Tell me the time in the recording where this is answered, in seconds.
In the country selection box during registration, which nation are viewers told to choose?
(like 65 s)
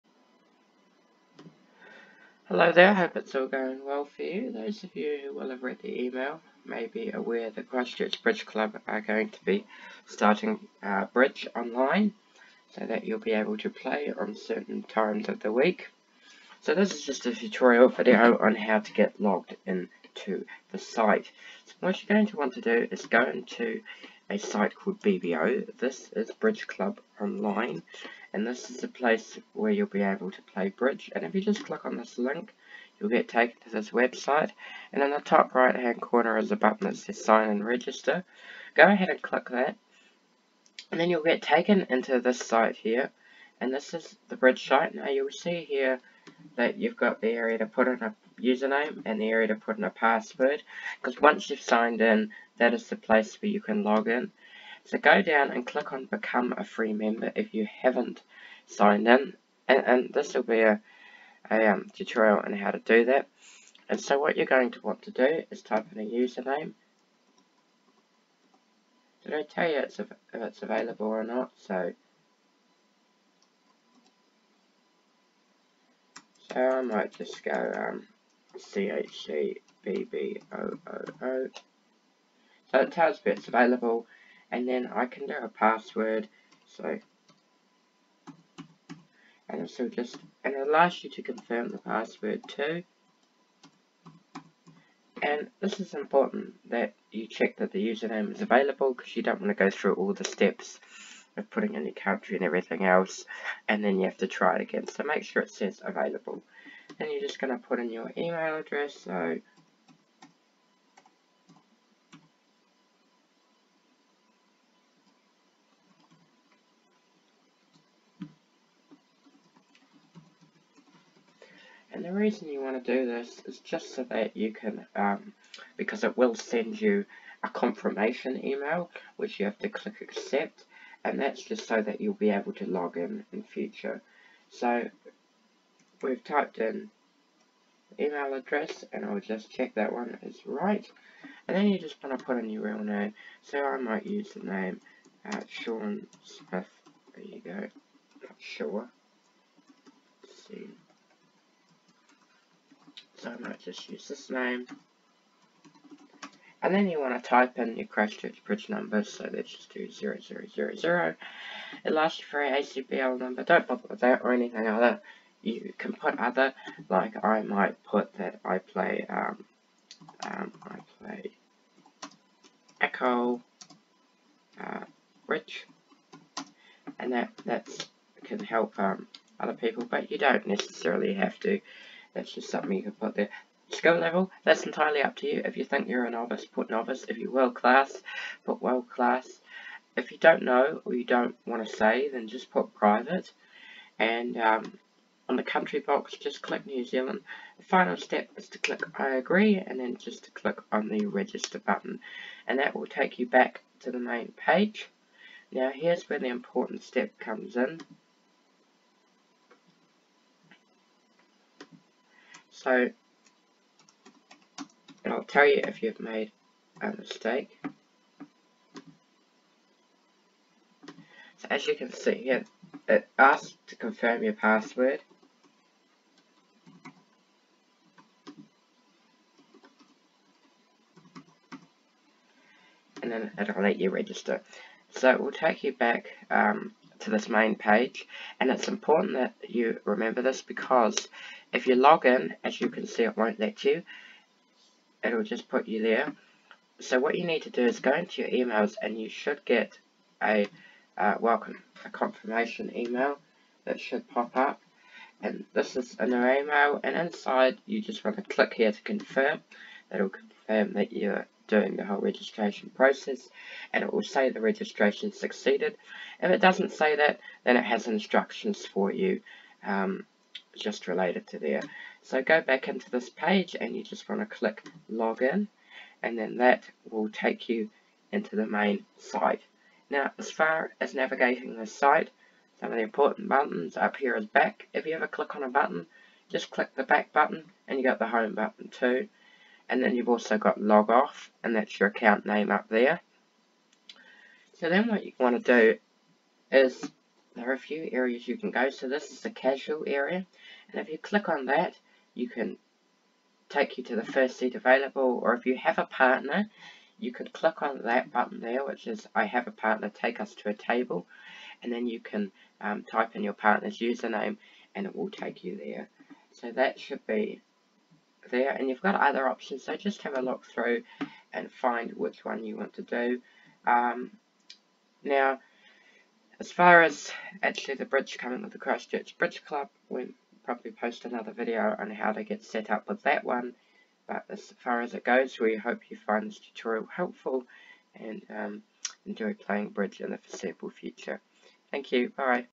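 196 s.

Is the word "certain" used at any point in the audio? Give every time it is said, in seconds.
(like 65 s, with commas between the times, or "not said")
14 s.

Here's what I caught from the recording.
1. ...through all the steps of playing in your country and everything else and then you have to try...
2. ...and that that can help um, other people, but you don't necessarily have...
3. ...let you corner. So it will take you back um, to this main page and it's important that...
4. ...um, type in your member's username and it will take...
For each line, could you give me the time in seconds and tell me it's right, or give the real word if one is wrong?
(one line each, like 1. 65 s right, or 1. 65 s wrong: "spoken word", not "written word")
1. 99 s wrong: "putting", not "playing"
2. 176 s right
3. 233 s wrong: "register", not "corner"
4. 312 s wrong: "partner", not "member".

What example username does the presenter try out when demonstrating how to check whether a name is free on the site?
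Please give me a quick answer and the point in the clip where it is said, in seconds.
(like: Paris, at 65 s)
CHCBBOOO, at 78 s.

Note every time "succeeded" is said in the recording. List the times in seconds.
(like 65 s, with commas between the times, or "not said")
265 s.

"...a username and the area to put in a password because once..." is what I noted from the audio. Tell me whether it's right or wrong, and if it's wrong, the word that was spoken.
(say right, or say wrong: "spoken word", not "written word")
right.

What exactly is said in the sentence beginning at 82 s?
So it tells me it's available and then I can do a password.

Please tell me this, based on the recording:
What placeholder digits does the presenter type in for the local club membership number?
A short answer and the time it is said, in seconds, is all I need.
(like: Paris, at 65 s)
0000, at 159 s.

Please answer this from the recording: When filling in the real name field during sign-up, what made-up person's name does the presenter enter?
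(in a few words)
Sean Smith.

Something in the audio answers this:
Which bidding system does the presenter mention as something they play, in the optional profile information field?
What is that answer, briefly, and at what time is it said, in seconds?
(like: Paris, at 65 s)
Acol, at 172 s.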